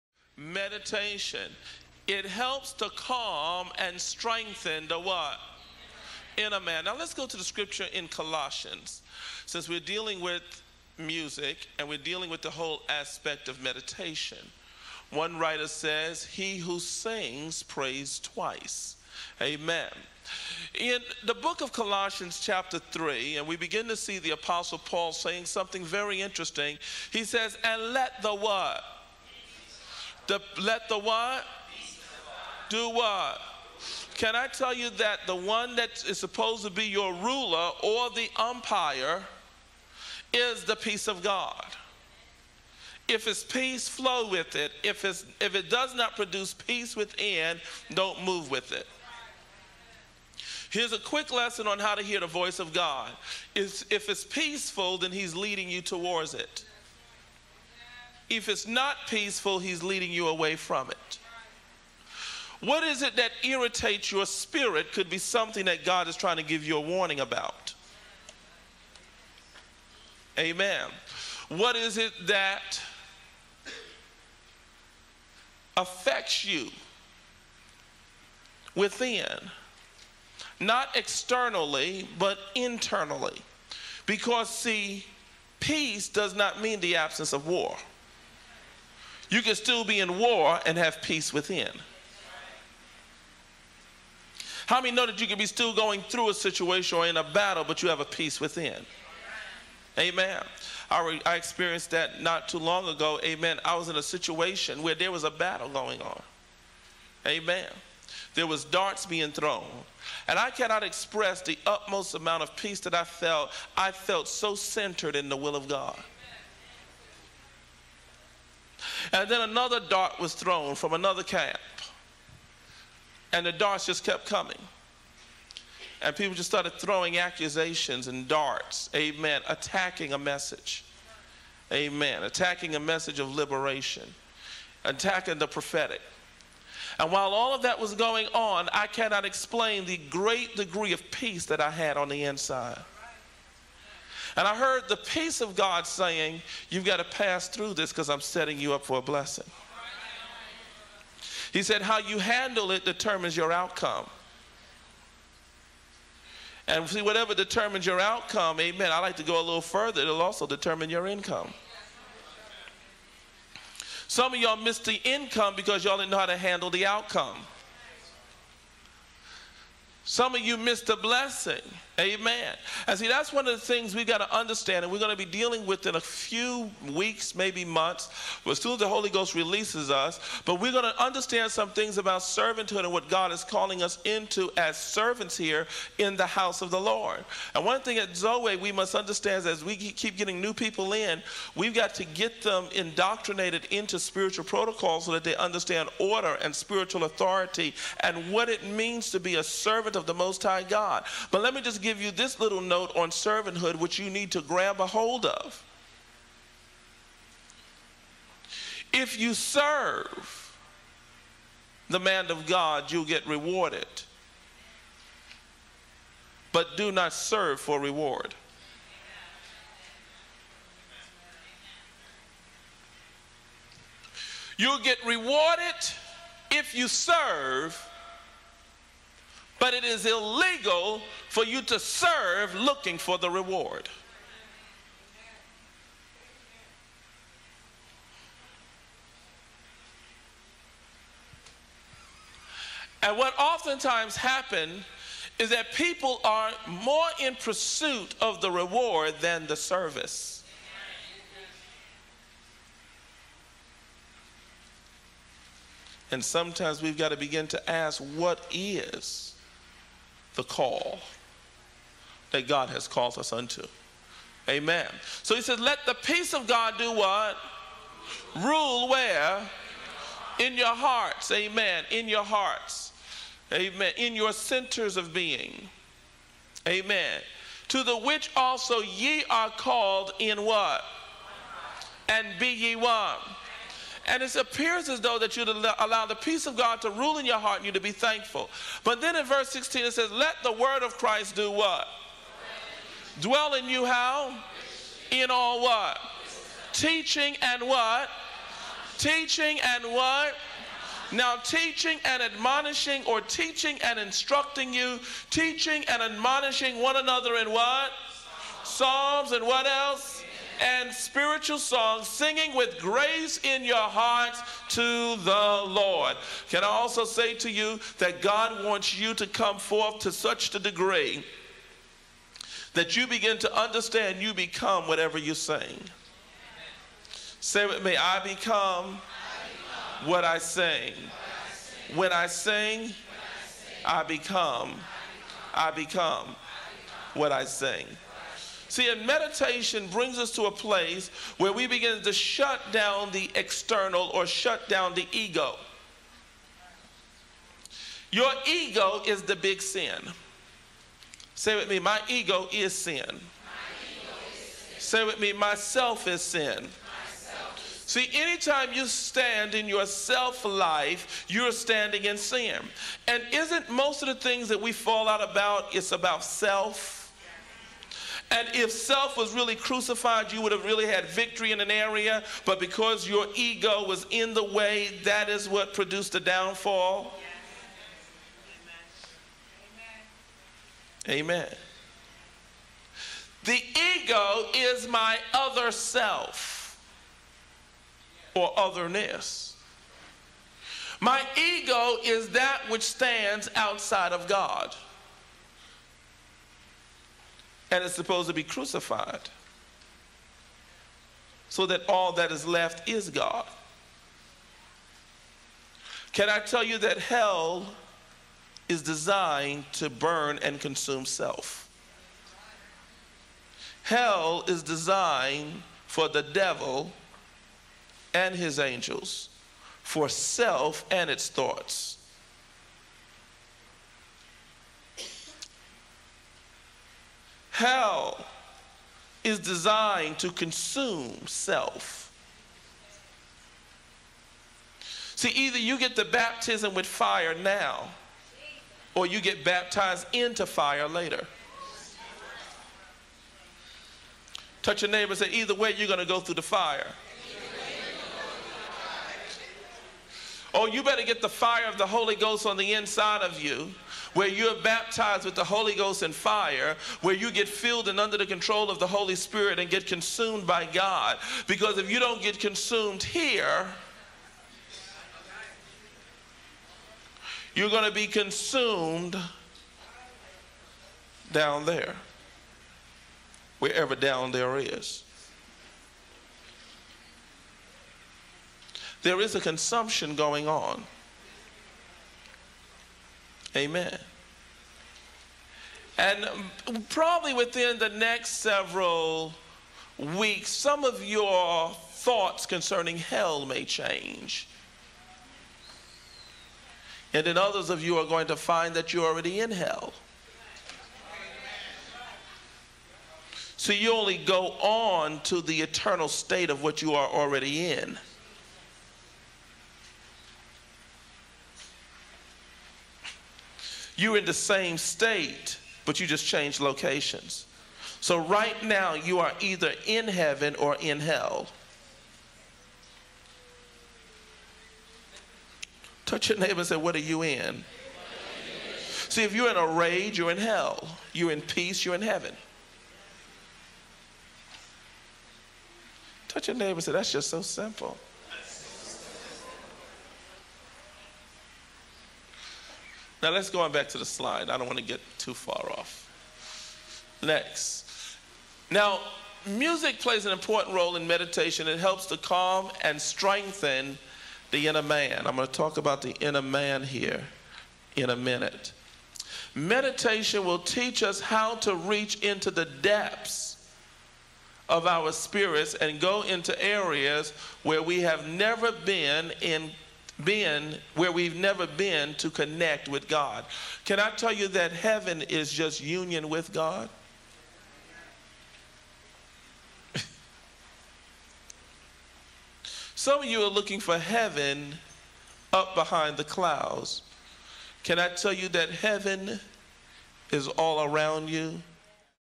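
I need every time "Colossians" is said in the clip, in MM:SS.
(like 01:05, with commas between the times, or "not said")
00:08, 00:21.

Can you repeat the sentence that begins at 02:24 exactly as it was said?
And I heard the peace of God saying, You've got to pass through this because I'm setting you up for a blessing.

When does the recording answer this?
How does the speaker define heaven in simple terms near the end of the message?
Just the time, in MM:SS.
09:35.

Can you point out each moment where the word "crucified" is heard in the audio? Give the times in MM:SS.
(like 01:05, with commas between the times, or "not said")
06:09, 06:38.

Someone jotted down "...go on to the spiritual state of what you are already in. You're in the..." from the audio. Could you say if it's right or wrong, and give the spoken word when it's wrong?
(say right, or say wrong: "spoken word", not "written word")
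wrong: "eternal", not "spiritual".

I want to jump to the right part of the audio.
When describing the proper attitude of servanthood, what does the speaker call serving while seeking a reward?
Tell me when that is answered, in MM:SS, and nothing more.
03:50.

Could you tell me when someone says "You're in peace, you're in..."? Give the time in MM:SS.
08:51.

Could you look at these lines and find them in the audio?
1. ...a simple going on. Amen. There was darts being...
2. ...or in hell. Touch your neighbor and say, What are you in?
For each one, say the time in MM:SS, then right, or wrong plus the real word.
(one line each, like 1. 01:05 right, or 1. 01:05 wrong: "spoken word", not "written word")
1. 01:45 wrong: "battle", not "simple"
2. 08:40 right.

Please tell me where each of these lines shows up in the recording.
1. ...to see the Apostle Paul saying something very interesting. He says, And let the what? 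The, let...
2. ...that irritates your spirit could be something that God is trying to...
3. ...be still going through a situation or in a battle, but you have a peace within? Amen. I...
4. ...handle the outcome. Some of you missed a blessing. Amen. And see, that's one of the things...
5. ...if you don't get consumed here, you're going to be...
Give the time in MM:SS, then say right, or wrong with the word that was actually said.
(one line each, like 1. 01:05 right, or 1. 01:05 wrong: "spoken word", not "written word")
1. 00:23 right
2. 01:03 right
3. 01:35 right
4. 02:46 right
5. 07:41 right.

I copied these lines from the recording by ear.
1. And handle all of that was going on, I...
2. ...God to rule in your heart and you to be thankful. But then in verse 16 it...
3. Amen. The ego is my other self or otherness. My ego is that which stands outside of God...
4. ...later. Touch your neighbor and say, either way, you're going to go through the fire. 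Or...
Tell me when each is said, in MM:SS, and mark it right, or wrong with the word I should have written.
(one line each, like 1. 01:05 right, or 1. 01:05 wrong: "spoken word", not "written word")
1. 02:16 wrong: "while", not "handle"
2. 04:46 right
3. 06:21 right
4. 07:20 right.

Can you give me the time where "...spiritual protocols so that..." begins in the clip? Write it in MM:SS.
03:13.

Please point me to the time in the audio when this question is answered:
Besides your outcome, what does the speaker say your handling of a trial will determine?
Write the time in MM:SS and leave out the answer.
02:40.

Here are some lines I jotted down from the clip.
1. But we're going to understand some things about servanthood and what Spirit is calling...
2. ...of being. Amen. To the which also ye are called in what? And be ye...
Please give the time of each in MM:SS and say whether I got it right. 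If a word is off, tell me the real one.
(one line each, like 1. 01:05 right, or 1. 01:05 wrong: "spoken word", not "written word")
1. 03:00 wrong: "God", not "Spirit"
2. 04:34 right.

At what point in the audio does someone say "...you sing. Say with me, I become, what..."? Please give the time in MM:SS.
05:25.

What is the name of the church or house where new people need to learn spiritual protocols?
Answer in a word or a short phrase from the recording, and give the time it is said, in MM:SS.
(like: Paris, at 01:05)
Zoe, at 03:08.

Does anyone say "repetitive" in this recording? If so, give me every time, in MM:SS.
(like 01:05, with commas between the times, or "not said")
not said.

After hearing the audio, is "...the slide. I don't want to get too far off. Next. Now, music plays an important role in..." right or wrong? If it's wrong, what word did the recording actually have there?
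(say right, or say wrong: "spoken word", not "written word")
right.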